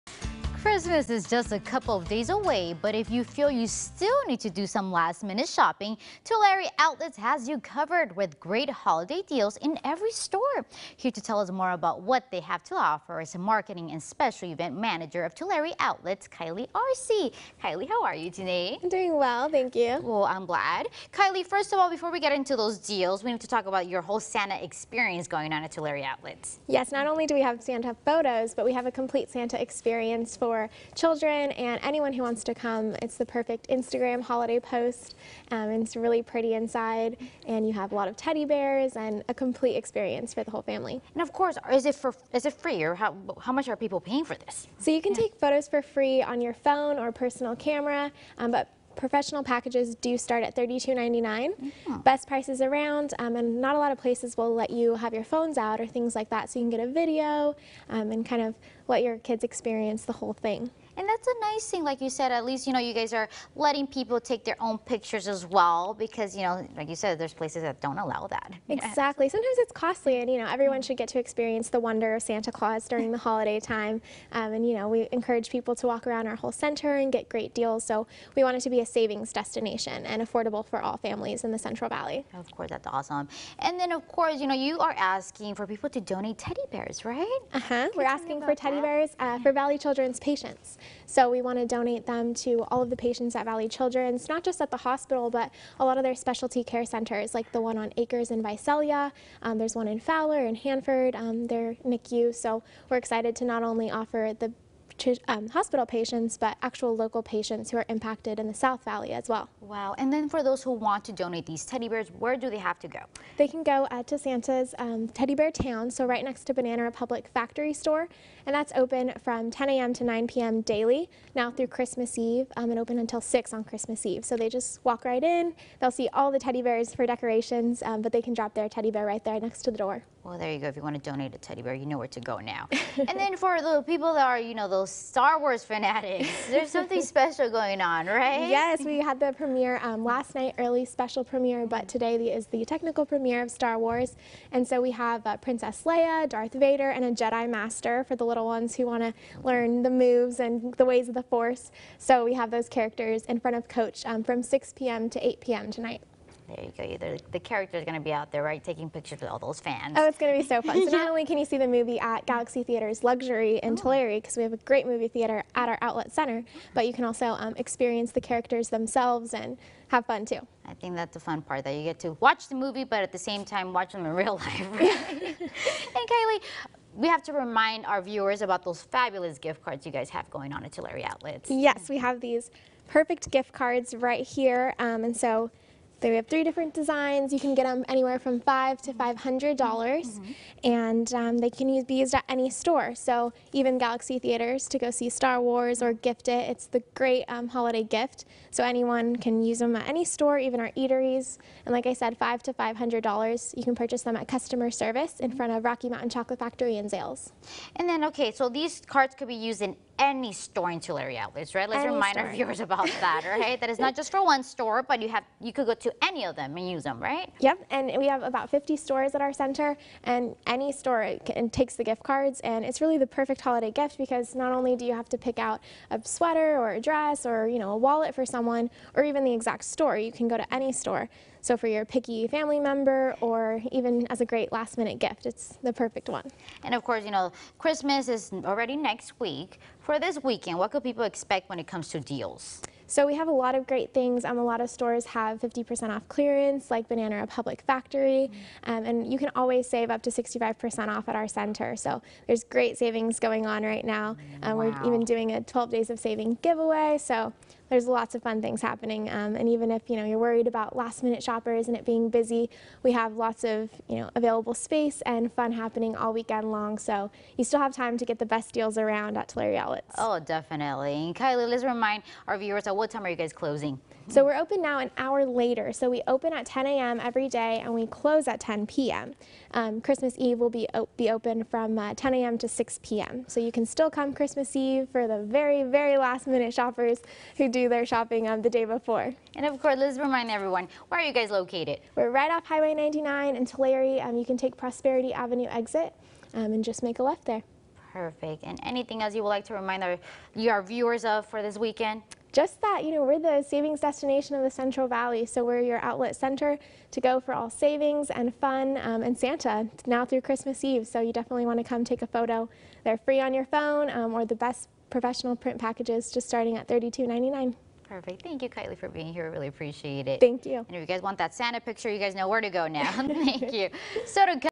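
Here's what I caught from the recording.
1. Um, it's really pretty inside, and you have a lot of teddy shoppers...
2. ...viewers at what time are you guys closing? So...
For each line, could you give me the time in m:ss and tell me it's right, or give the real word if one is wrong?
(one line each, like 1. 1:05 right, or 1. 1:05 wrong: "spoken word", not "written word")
1. 0:35 wrong: "bears", not "shoppers"
2. 4:32 right.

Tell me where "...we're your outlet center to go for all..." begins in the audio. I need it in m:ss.
5:05.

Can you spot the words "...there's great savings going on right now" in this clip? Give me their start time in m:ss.
4:12.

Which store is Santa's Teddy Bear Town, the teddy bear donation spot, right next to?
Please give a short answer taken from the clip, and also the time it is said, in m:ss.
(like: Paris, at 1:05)
Banana Republic Factory Store, at 1:56.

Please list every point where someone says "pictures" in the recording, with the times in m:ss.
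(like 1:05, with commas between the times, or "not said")
1:04, 2:38, 5:21.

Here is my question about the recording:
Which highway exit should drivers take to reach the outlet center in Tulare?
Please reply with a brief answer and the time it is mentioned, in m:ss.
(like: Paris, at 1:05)
Prosperity Avenue, at 4:54.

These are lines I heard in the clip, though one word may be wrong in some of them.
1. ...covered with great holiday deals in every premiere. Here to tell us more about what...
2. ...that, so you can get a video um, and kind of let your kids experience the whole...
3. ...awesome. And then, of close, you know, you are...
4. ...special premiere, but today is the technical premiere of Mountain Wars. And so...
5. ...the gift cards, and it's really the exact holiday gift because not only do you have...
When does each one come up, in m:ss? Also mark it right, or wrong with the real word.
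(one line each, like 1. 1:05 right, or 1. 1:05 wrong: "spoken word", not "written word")
1. 0:07 wrong: "store", not "premiere"
2. 0:56 right
3. 1:22 wrong: "course", not "close"
4. 2:20 wrong: "Star", not "Mountain"
5. 3:41 wrong: "perfect", not "exact".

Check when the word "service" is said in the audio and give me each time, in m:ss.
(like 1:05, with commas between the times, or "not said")
3:24.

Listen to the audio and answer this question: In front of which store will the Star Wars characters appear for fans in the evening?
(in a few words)
Coach.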